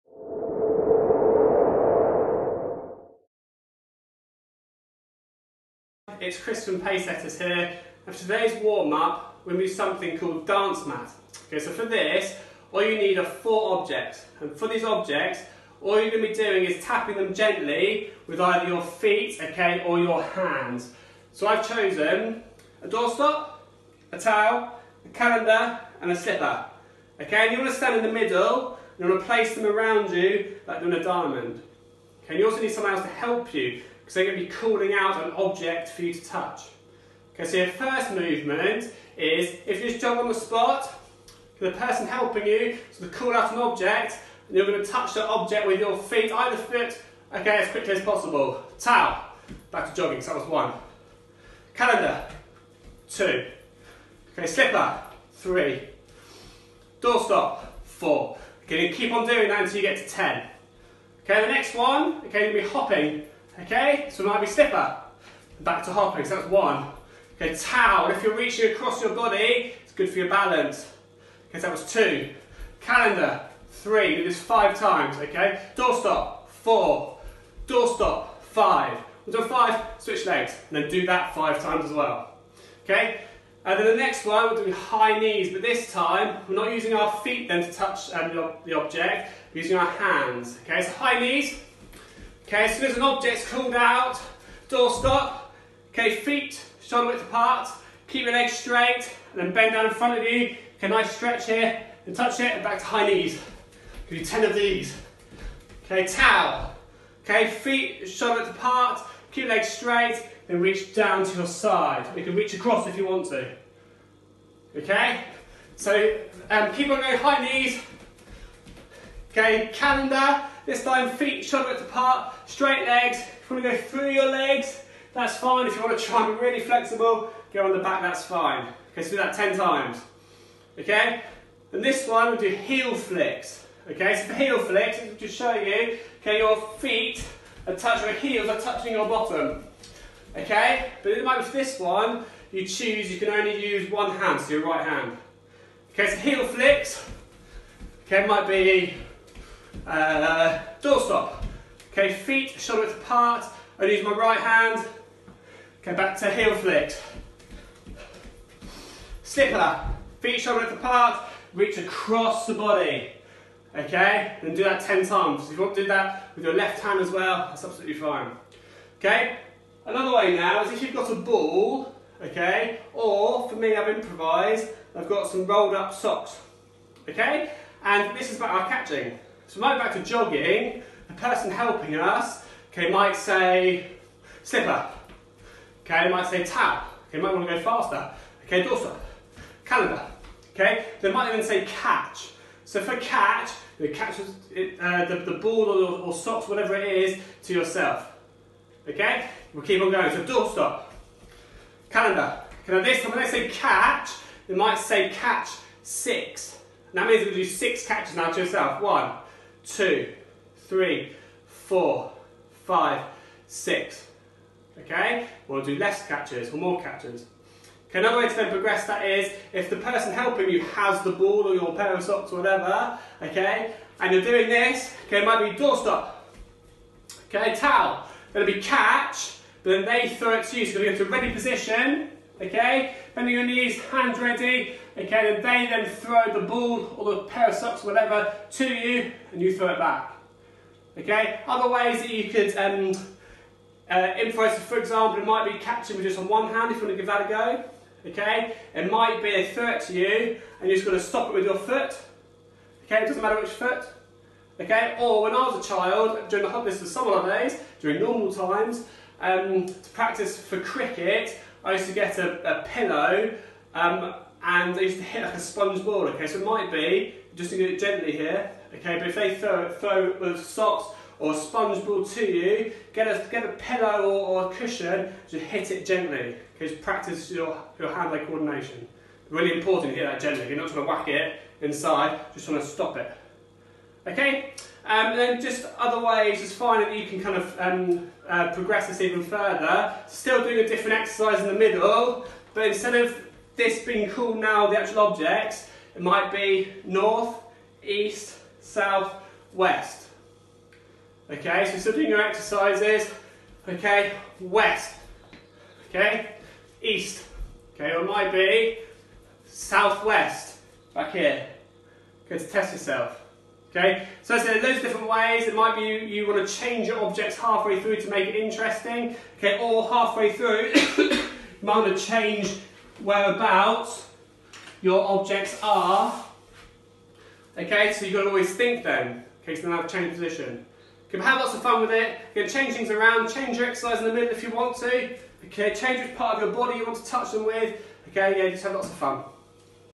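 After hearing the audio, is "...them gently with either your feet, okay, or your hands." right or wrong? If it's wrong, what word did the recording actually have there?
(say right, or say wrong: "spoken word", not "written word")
right.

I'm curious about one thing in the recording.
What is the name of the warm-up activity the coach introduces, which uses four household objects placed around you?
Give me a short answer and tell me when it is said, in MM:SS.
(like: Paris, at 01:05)
Dance mat, at 00:10.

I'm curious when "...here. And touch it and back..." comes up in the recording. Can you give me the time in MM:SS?
01:41.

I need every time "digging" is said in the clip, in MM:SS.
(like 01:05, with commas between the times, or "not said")
not said.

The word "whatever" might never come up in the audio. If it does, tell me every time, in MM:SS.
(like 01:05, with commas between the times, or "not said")
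03:16, 03:42, 03:57.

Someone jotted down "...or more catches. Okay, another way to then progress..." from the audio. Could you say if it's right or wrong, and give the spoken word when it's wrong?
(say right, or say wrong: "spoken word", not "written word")
right.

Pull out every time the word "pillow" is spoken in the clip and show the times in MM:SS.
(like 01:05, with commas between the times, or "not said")
04:22, 04:33.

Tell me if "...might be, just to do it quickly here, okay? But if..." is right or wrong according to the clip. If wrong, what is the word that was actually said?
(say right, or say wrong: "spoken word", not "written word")
wrong: "gently", not "quickly".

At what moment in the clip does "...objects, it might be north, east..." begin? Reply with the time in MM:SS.
04:54.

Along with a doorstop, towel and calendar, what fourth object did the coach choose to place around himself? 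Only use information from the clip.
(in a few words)
A slipper.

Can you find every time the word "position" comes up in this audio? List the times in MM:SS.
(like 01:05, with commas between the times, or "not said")
03:51, 05:30.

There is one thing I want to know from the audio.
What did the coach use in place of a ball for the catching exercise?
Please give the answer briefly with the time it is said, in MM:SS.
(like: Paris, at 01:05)
Rolled up socks, at 02:55.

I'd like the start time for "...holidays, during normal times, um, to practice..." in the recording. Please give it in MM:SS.
04:17.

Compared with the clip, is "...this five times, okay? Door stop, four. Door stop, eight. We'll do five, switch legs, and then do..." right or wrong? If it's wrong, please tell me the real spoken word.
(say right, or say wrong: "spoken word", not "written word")
wrong: "five", not "eight".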